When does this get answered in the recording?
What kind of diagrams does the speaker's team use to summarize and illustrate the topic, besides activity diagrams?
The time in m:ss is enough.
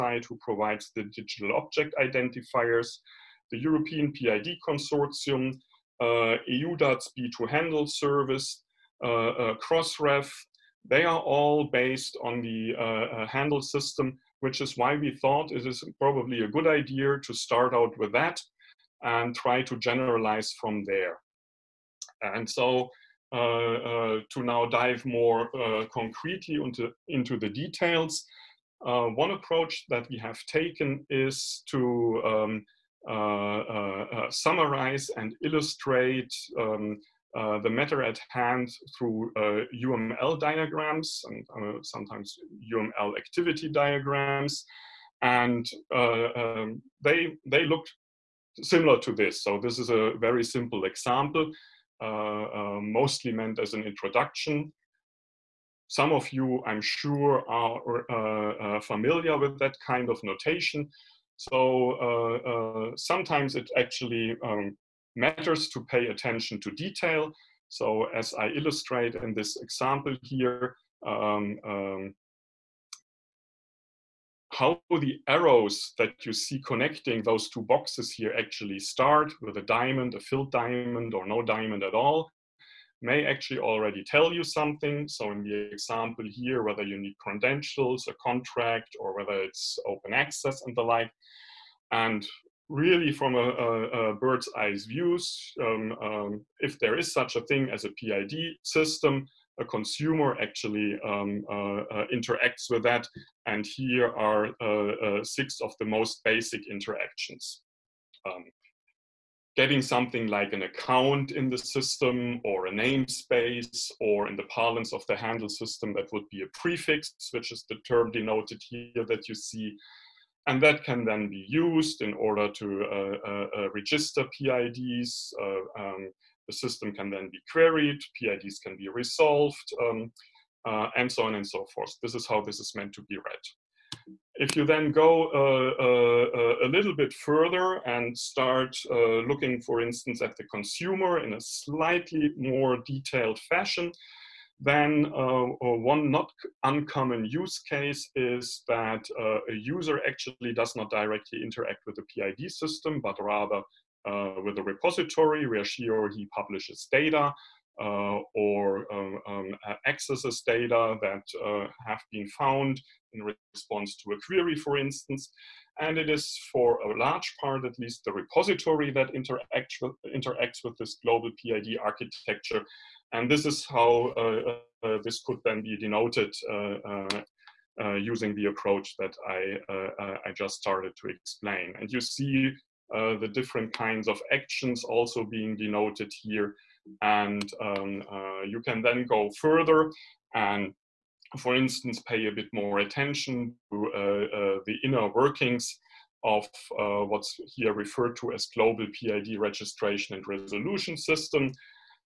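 0:39.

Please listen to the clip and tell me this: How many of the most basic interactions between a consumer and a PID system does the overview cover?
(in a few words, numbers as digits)
6.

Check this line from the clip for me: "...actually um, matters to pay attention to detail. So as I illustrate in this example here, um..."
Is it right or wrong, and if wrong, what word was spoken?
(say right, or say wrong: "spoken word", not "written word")
right.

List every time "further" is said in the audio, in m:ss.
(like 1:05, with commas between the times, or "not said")
2:17, 3:09.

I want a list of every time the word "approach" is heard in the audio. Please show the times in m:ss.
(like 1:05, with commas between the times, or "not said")
0:29, 2:58.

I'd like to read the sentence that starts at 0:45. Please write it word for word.
And uh, um, they, they looked similar to this.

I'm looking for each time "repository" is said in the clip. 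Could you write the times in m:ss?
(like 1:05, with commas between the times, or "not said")
2:34, 2:48.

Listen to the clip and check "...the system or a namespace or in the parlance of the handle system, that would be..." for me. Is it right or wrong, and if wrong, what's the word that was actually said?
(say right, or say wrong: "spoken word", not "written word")
right.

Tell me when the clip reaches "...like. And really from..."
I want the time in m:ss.
1:30.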